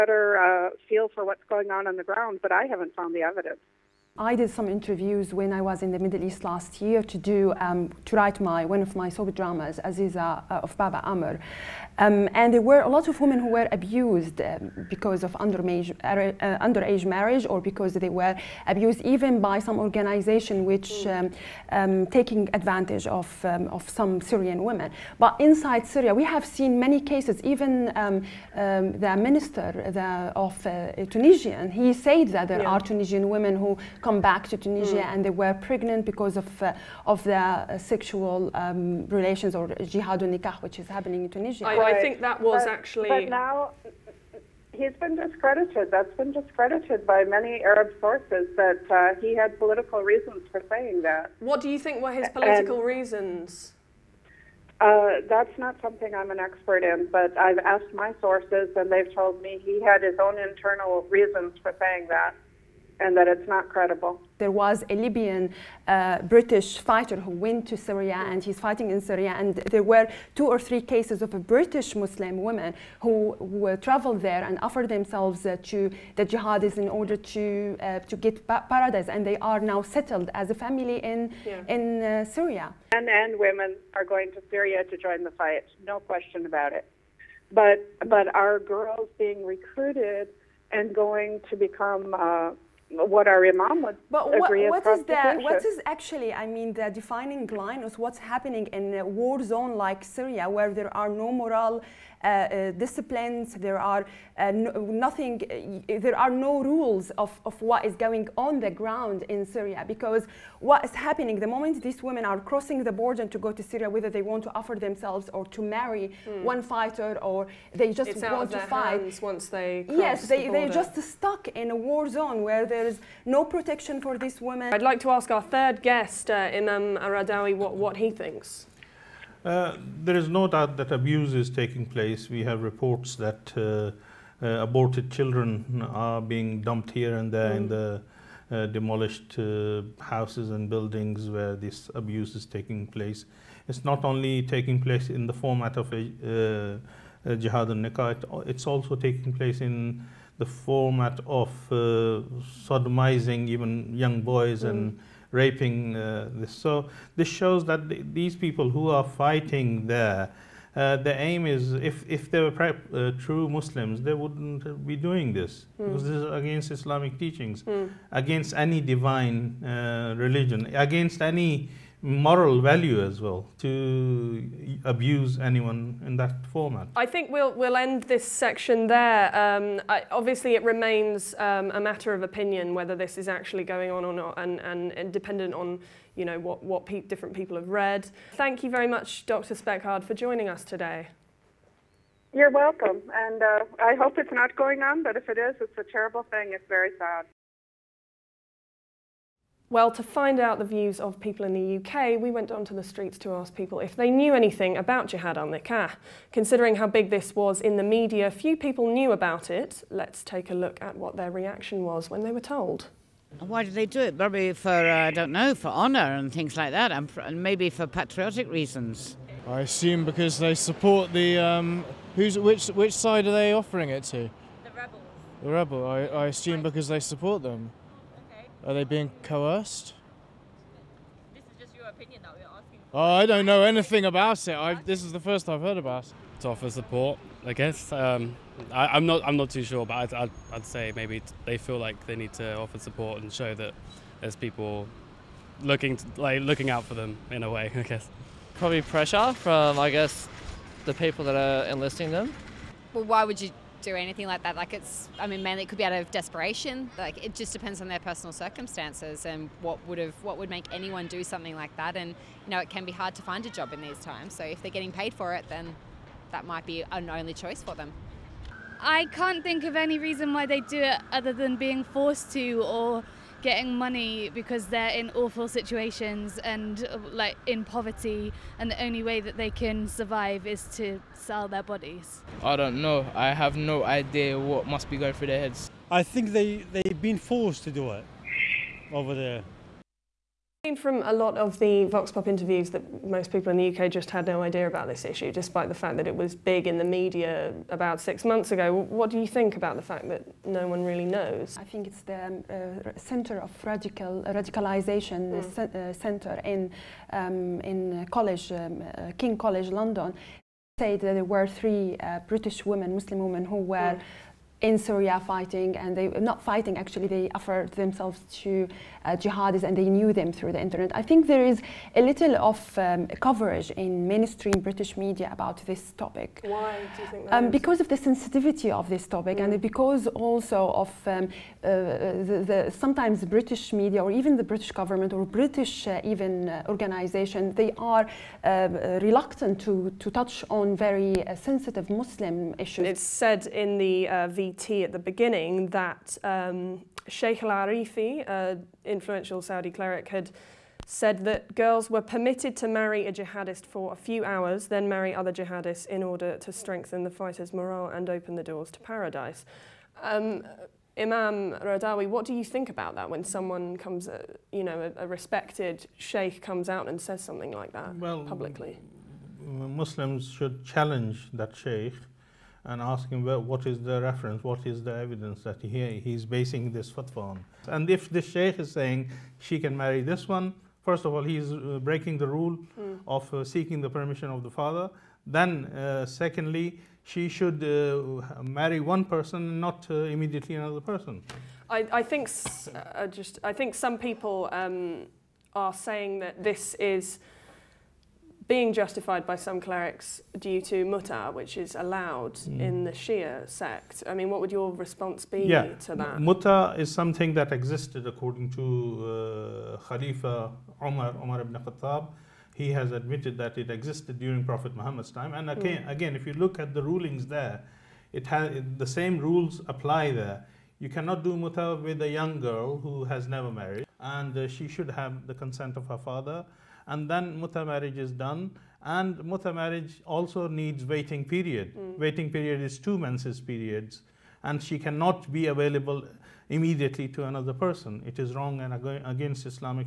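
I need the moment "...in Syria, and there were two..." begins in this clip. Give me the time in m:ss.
1:08.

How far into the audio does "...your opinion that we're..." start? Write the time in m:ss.
3:51.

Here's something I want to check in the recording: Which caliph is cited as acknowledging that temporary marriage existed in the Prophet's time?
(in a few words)
Umar ibn Khattab.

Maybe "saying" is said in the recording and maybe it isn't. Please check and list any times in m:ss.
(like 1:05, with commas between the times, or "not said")
0:50, 1:01, 6:18, 6:35.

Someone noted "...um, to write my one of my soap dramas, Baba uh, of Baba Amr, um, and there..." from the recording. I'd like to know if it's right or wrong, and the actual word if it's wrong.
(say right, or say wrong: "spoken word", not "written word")
wrong: "Aziza", not "Baba".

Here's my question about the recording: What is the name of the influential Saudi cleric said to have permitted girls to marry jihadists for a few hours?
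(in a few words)
Sheikh al-Arifi.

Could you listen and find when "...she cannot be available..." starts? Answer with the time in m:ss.
7:14.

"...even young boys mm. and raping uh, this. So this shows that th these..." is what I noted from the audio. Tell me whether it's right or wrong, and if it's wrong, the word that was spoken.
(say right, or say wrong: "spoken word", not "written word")
right.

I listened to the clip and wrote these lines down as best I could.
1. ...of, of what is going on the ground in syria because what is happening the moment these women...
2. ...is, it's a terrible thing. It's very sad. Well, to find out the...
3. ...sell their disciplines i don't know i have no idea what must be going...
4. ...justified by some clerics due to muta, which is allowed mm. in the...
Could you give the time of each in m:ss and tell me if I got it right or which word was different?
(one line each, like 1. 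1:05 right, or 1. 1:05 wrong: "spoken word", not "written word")
1. 1:47 right
2. 3:15 right
3. 4:41 wrong: "bodies", not "disciplines"
4. 6:38 right.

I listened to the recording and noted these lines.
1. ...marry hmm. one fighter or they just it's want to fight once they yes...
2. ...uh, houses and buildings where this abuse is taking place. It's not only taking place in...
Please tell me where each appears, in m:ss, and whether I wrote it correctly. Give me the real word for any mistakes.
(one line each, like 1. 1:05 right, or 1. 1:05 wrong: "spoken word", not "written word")
1. 1:55 right
2. 2:19 right.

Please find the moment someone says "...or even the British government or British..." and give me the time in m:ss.
5:34.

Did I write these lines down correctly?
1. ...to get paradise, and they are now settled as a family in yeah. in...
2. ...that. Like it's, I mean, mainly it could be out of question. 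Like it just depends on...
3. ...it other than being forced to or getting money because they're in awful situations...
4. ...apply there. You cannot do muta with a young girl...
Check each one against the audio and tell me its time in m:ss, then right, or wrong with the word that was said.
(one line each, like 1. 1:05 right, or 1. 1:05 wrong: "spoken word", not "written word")
1. 1:18 right
2. 4:14 wrong: "desperation", not "question"
3. 4:30 right
4. 6:59 right.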